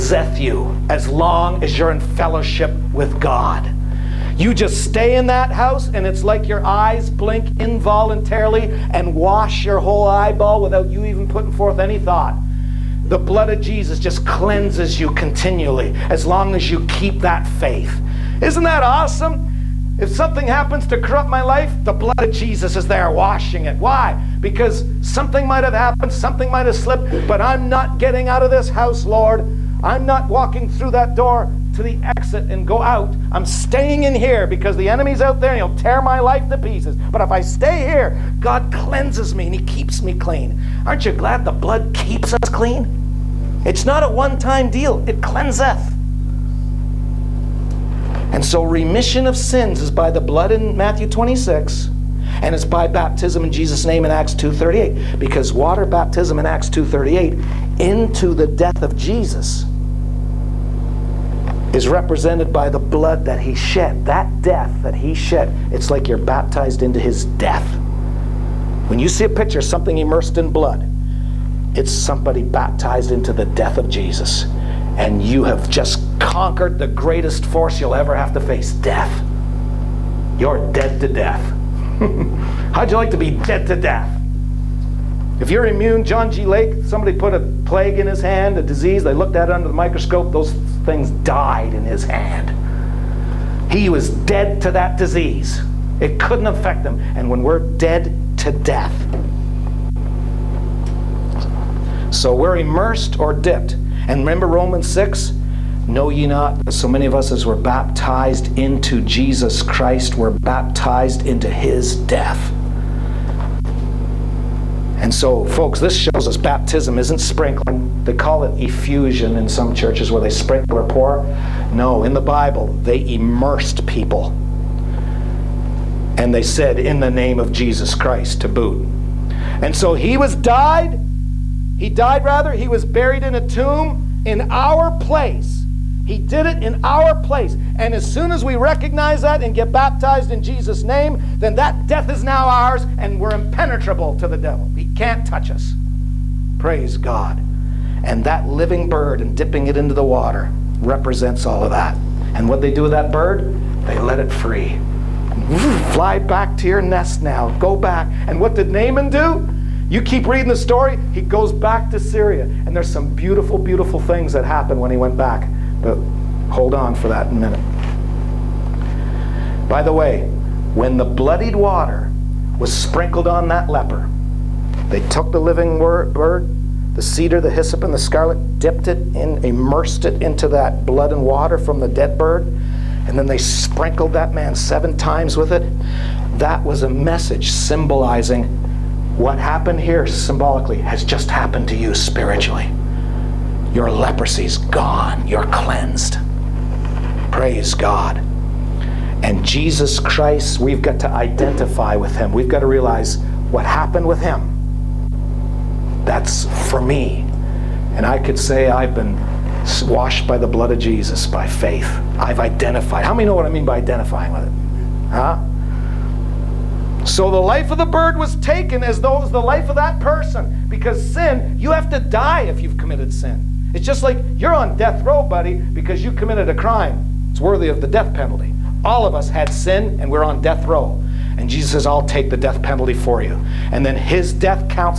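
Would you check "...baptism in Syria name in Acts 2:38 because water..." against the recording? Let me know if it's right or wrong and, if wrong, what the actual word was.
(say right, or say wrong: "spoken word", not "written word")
wrong: "Jesus", not "Syria".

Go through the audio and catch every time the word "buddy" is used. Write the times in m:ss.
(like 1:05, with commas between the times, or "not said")
3:45.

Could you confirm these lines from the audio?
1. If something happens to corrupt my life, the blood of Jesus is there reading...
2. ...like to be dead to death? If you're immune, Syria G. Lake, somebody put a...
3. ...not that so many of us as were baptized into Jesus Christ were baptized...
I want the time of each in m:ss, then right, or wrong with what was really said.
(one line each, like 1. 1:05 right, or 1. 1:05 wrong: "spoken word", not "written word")
1. 0:20 wrong: "washing", not "reading"
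2. 1:22 wrong: "John", not "Syria"
3. 1:46 right.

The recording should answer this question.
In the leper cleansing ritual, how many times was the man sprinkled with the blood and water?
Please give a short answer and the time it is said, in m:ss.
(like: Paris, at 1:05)
7, at 3:04.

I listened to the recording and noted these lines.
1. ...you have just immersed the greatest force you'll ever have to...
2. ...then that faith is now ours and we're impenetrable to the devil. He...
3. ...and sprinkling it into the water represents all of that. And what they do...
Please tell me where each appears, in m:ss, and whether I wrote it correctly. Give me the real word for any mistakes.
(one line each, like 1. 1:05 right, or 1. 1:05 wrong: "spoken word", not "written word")
1. 1:15 wrong: "conquered", not "immersed"
2. 2:21 wrong: "death", not "faith"
3. 2:29 wrong: "dipping", not "sprinkling".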